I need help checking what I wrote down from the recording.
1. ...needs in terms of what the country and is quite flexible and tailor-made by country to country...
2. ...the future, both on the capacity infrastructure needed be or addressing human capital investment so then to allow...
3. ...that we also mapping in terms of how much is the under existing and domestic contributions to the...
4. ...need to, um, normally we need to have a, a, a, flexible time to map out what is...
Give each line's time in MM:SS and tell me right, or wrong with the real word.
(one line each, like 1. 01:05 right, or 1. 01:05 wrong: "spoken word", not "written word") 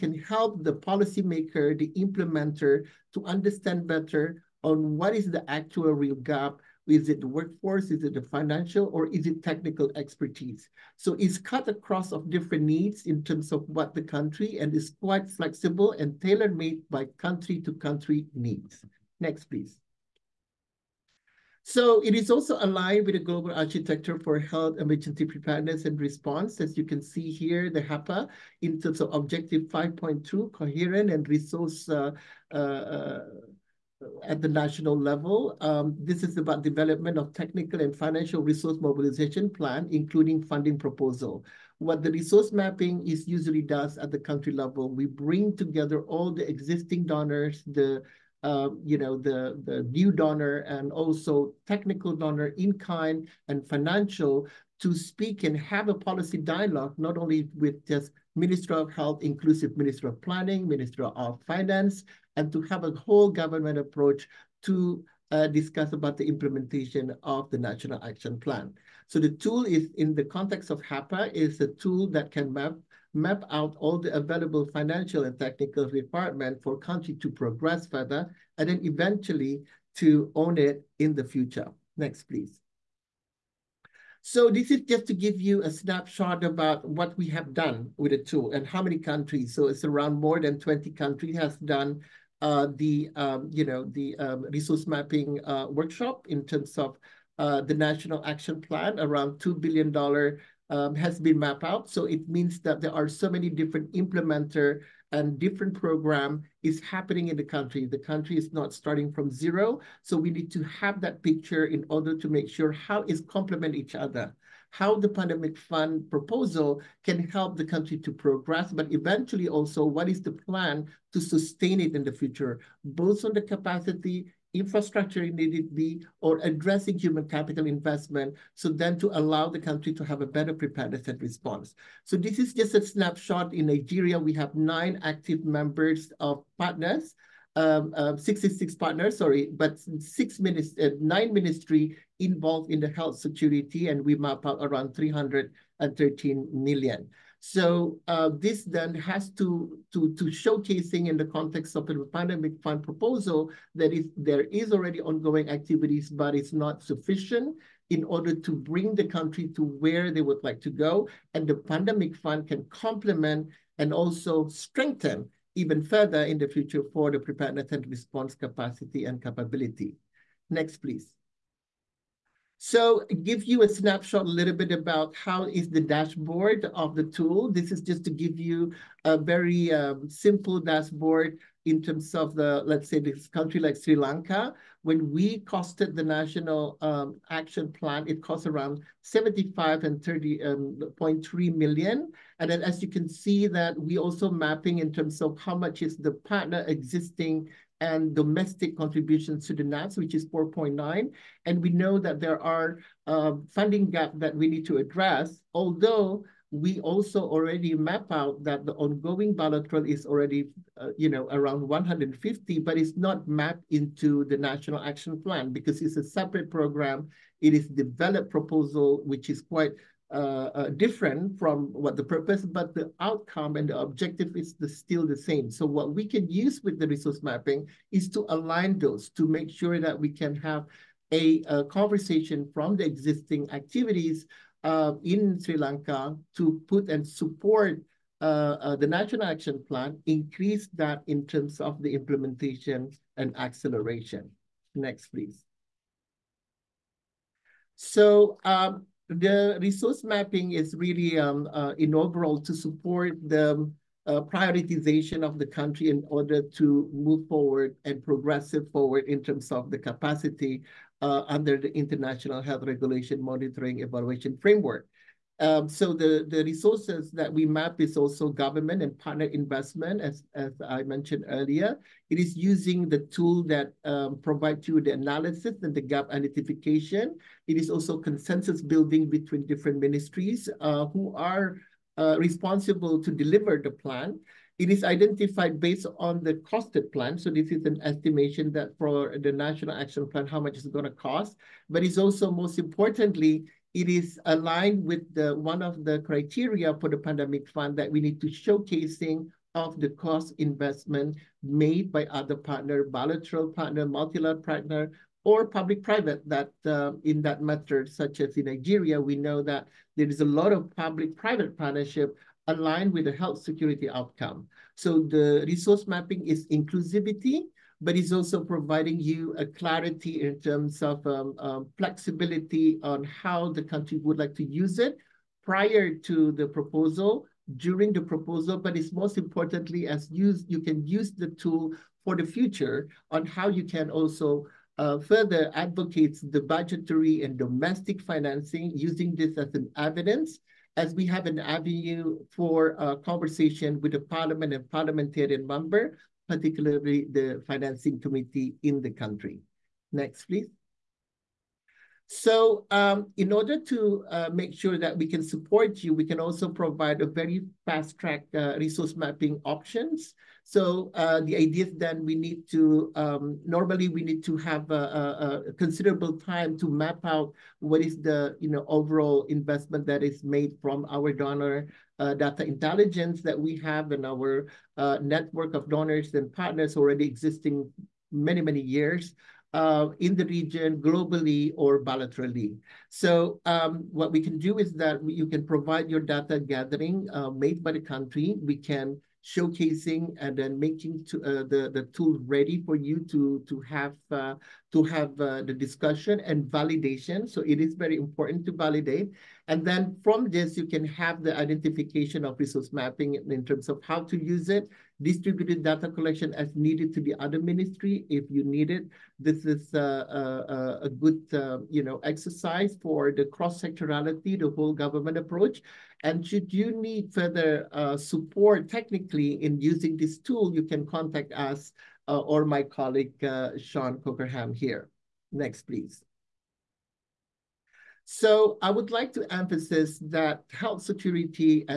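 1. 00:12 right
2. 02:02 right
3. 03:13 wrong: "partner", not "under"
4. 06:02 wrong: "considerable", not "flexible".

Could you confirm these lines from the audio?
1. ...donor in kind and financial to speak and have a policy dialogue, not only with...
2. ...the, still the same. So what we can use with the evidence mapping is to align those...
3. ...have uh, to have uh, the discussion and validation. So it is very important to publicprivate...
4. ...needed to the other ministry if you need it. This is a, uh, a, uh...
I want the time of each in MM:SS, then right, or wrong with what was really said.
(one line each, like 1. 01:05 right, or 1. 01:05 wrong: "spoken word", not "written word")
1. 00:52 right
2. 03:44 wrong: "resource", not "evidence"
3. 06:33 wrong: "validate", not "publicprivate"
4. 06:46 right.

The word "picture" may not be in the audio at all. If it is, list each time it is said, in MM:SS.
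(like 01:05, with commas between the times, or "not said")
01:51.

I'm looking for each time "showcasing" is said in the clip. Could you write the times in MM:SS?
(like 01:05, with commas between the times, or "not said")
02:30, 04:58, 06:29.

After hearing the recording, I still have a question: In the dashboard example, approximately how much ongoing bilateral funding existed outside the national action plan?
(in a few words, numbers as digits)
150.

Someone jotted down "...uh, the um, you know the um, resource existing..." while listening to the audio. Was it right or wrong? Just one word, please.
wrong.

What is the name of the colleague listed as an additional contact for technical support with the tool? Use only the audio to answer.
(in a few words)
Sean Cockerham.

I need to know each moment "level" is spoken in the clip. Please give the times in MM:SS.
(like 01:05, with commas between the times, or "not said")
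00:34, 00:44.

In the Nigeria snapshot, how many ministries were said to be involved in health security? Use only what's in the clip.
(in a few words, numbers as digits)
9.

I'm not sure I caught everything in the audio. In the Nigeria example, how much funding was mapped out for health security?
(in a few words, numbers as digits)
313 million.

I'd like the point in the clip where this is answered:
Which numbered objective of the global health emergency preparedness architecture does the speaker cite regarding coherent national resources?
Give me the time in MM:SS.
00:29.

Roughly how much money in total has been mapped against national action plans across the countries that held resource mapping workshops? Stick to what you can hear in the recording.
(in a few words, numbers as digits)
2 billion dollars.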